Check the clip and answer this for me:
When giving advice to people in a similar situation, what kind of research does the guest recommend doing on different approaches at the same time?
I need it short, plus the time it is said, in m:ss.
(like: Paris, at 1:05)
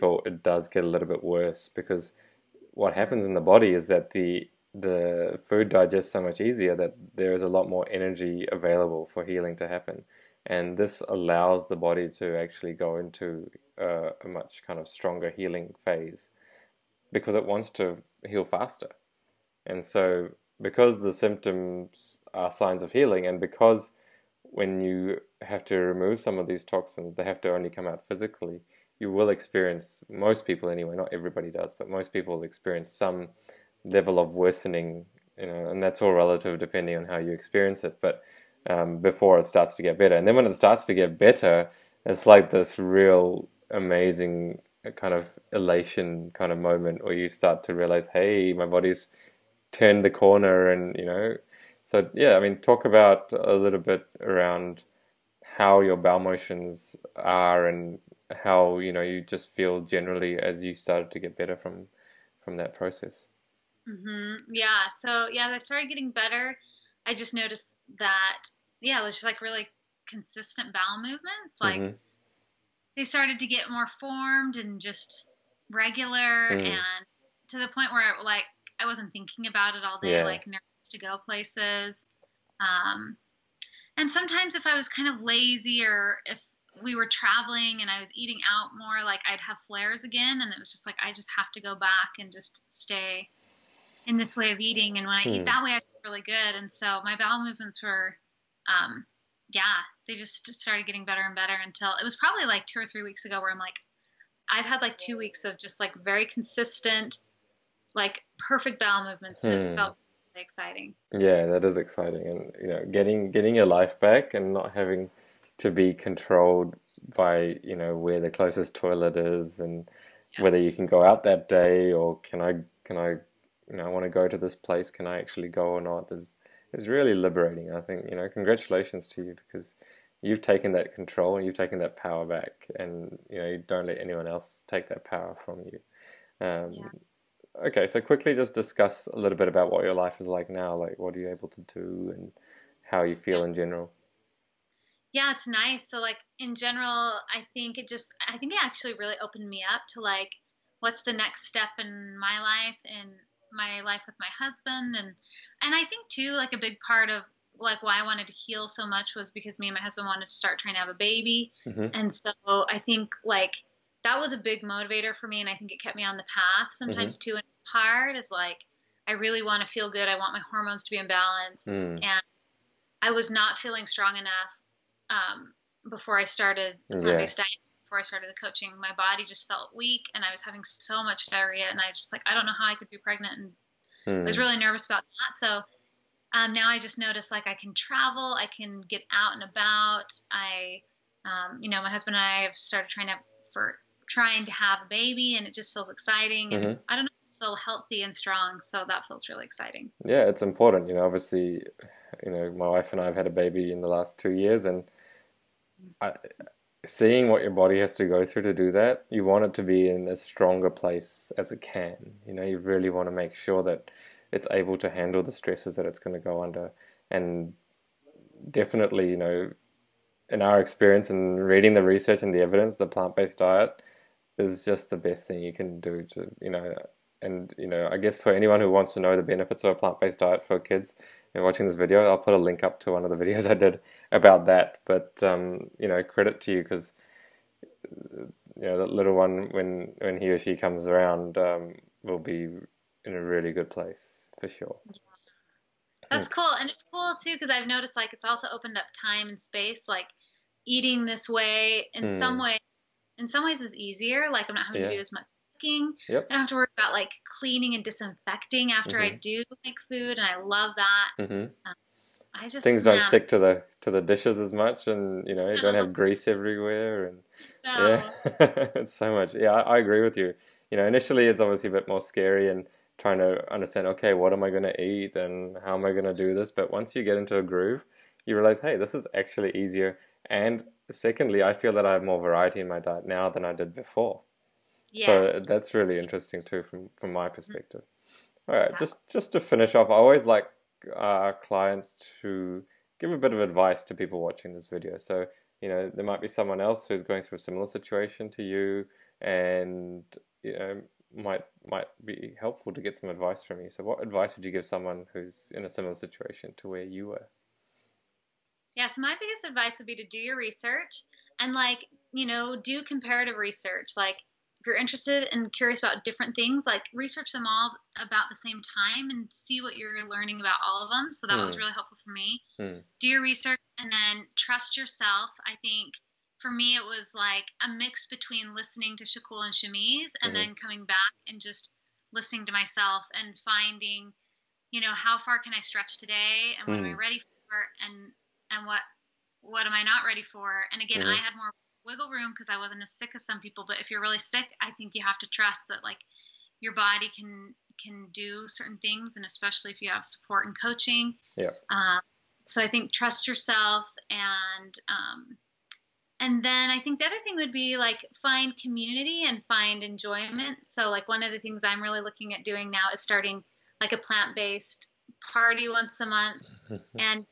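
Comparative research, at 5:12.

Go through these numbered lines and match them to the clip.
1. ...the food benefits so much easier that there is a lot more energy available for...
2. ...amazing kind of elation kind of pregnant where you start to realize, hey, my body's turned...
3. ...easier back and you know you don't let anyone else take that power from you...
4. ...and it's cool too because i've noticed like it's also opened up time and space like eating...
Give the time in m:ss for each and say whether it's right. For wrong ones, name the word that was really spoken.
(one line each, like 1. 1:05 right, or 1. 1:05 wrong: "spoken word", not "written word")
1. 0:04 wrong: "digests", not "benefits"
2. 0:43 wrong: "moment", not "pregnant"
3. 2:11 wrong: "power", not "easier"
4. 4:06 right.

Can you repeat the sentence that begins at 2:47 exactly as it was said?
too and it's hard is like i really want to feel good i want my hormones to be in balance mm.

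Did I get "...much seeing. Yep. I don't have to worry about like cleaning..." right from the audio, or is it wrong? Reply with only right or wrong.
wrong.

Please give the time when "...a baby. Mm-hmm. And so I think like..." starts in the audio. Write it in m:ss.
2:40.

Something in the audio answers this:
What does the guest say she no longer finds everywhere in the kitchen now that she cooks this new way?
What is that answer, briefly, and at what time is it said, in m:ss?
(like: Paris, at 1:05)
Grease, at 4:25.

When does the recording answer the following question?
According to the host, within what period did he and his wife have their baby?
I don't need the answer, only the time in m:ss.
3:23.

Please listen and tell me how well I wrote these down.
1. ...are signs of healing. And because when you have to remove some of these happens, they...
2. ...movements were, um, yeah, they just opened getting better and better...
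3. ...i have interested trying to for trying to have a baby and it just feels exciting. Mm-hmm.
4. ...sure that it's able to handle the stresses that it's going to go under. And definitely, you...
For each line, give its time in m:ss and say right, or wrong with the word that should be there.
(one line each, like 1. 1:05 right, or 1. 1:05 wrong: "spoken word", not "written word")
1. 0:22 wrong: "toxins", not "happens"
2. 1:37 wrong: "started", not "opened"
3. 3:12 wrong: "started", not "interested"
4. 3:33 right.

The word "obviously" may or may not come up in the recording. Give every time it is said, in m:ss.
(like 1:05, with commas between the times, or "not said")
3:21, 4:31.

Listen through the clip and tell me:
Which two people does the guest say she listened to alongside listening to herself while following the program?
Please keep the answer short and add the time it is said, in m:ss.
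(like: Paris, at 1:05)
Shakul and Shamiz, at 5:29.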